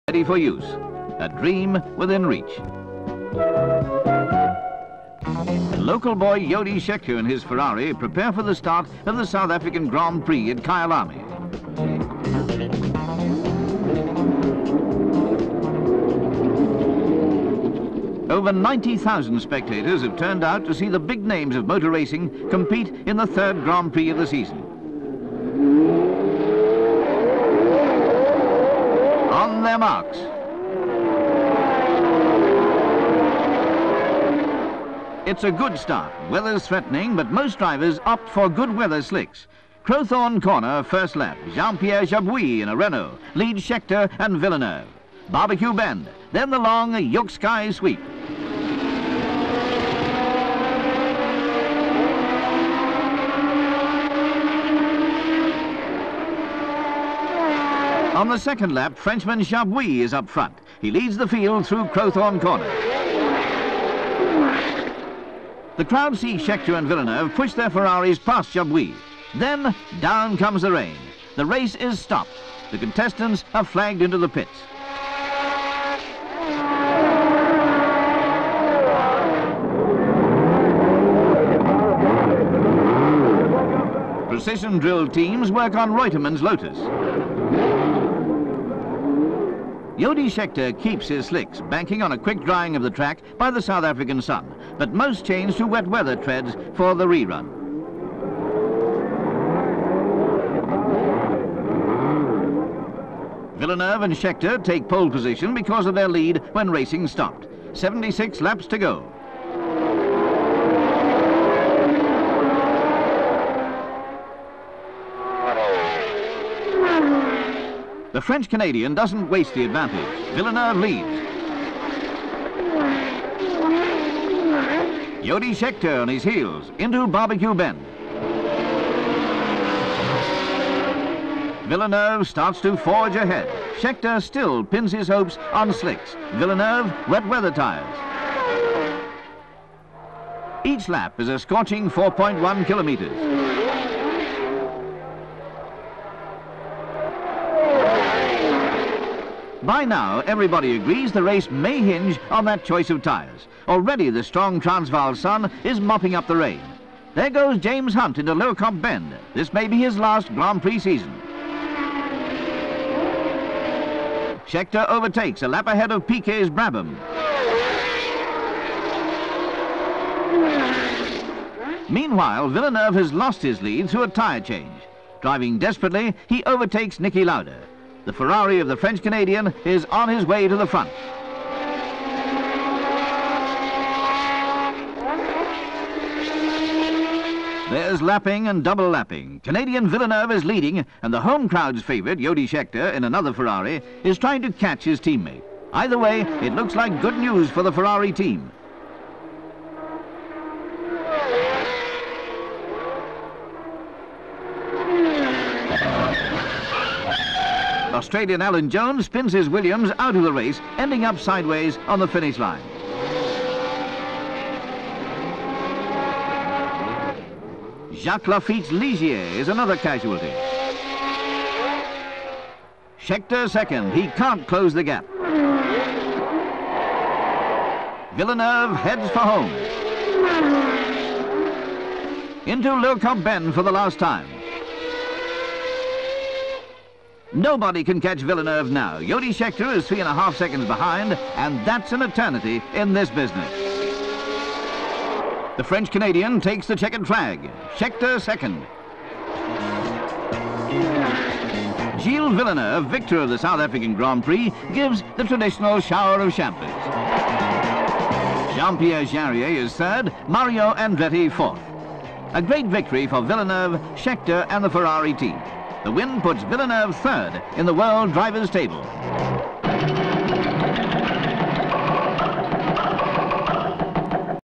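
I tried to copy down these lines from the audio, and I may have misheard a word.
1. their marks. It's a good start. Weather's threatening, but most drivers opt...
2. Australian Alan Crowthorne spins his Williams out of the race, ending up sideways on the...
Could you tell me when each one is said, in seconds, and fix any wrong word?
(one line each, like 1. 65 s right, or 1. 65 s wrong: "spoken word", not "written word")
1. 29 s right
2. 207 s wrong: "Jones", not "Crowthorne".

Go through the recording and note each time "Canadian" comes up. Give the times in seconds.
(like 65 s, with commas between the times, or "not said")
118 s, 178 s, 189 s, 245 s.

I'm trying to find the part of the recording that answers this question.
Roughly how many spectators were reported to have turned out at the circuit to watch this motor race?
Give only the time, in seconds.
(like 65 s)
18 s.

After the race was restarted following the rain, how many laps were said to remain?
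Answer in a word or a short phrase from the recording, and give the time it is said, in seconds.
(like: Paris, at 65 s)
76, at 107 s.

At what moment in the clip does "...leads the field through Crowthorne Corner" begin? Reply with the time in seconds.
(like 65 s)
60 s.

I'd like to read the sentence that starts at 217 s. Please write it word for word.
Jacques Laffite's Ligier is another casualty.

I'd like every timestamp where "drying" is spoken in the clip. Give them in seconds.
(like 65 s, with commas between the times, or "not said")
92 s.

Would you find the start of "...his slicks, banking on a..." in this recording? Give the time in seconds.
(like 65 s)
91 s.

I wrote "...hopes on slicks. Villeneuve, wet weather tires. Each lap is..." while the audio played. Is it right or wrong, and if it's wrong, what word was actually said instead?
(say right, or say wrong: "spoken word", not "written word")
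right.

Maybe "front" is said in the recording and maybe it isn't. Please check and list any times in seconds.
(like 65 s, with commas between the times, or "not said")
60 s, 180 s.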